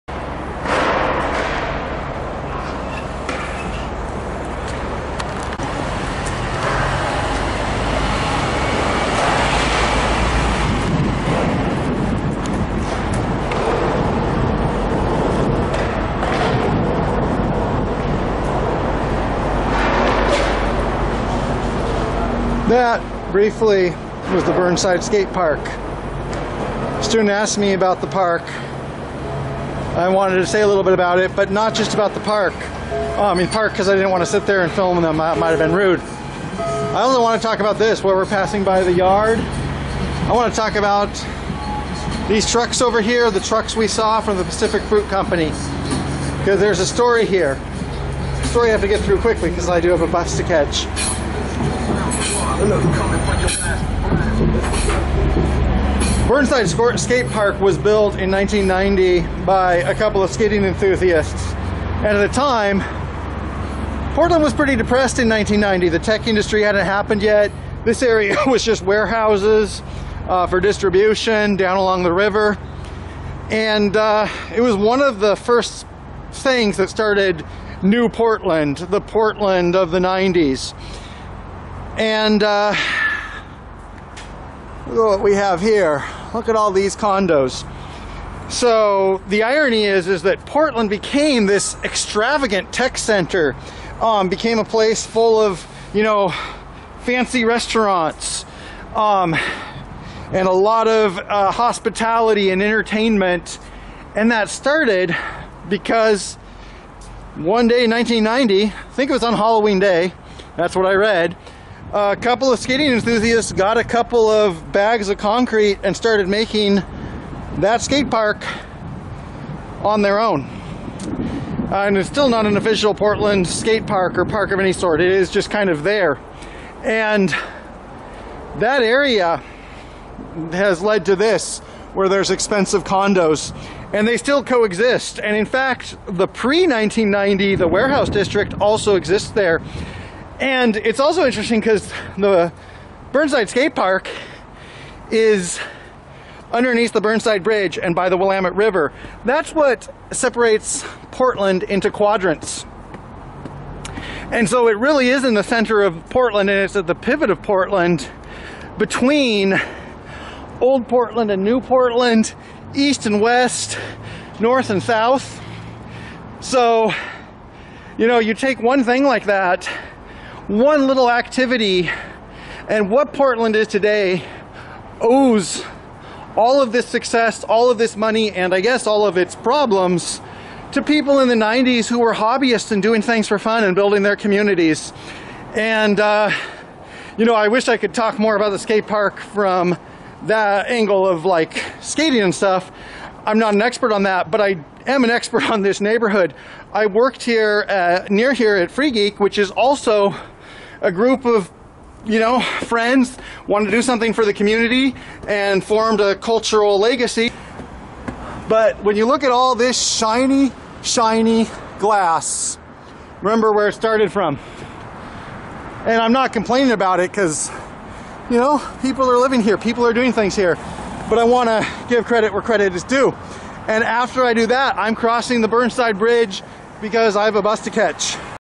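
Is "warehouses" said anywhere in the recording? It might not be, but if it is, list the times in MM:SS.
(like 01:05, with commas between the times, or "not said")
01:08, 02:17.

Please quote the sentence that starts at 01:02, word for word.
And at the time, Portland was pretty depressed in 1990.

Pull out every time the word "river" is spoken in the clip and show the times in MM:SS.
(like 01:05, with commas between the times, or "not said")
01:12, 02:28.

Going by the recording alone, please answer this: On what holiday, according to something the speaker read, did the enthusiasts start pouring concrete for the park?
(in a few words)
Halloween.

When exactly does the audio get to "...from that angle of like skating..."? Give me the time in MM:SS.
03:09.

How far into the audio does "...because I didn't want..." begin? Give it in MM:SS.
00:33.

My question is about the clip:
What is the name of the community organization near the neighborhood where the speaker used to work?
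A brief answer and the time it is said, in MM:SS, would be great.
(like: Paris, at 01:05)
Free Geek, at 03:18.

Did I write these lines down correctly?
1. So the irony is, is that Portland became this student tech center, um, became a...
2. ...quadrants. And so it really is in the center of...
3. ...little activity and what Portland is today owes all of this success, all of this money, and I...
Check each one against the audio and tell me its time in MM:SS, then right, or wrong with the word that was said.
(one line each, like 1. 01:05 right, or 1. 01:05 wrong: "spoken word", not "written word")
1. 01:28 wrong: "extravagant", not "student"
2. 02:31 right
3. 02:50 right.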